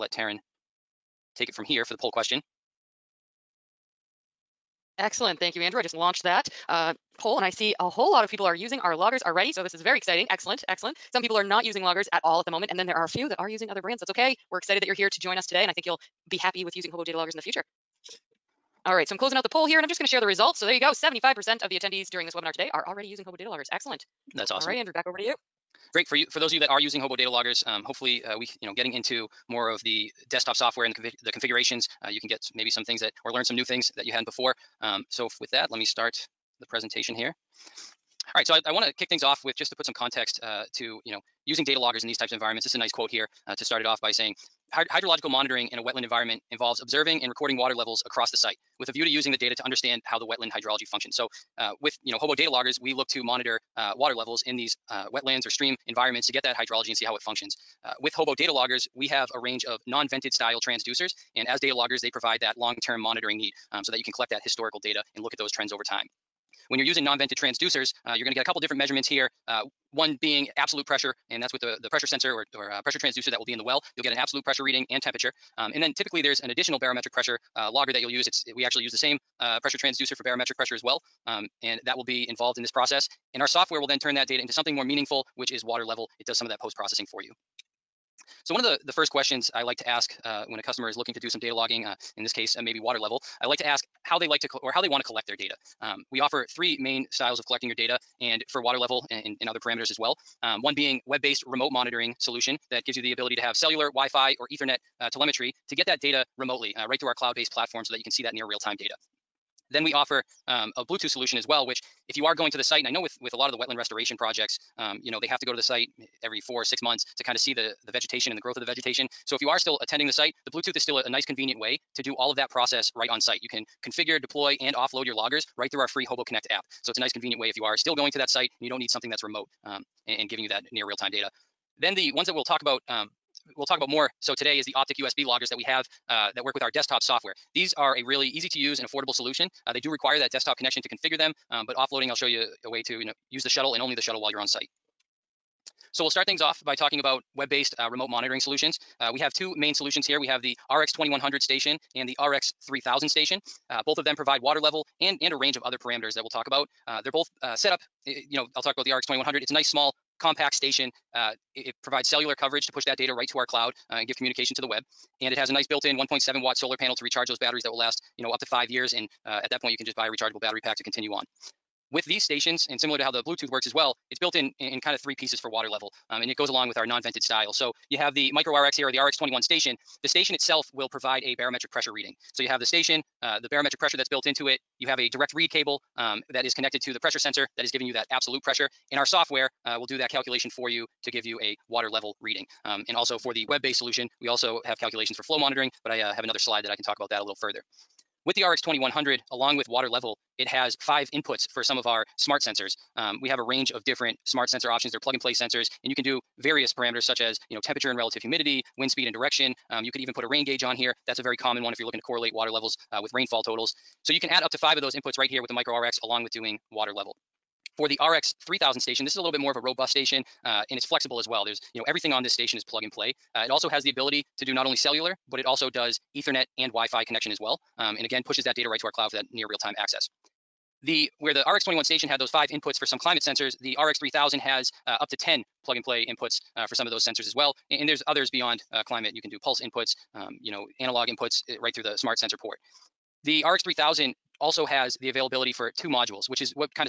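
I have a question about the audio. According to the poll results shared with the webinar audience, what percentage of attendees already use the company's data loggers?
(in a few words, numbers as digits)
75%.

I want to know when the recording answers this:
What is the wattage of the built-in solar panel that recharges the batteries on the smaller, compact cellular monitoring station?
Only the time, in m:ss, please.
2:45.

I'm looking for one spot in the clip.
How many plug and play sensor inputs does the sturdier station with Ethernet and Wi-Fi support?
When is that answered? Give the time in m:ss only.
3:55.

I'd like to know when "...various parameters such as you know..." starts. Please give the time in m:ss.
3:26.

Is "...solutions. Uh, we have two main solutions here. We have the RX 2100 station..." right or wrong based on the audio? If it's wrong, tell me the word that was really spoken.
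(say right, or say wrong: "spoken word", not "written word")
right.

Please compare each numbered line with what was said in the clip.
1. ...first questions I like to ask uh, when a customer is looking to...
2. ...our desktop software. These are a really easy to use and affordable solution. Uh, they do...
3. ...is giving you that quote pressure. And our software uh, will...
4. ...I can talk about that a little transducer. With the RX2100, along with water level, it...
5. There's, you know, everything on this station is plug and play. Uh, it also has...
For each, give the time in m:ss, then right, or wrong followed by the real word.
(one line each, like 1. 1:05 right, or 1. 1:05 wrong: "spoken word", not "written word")
1. 1:28 right
2. 2:16 right
3. 3:07 wrong: "absolute", not "quote"
4. 3:16 wrong: "further", not "transducer"
5. 3:41 right.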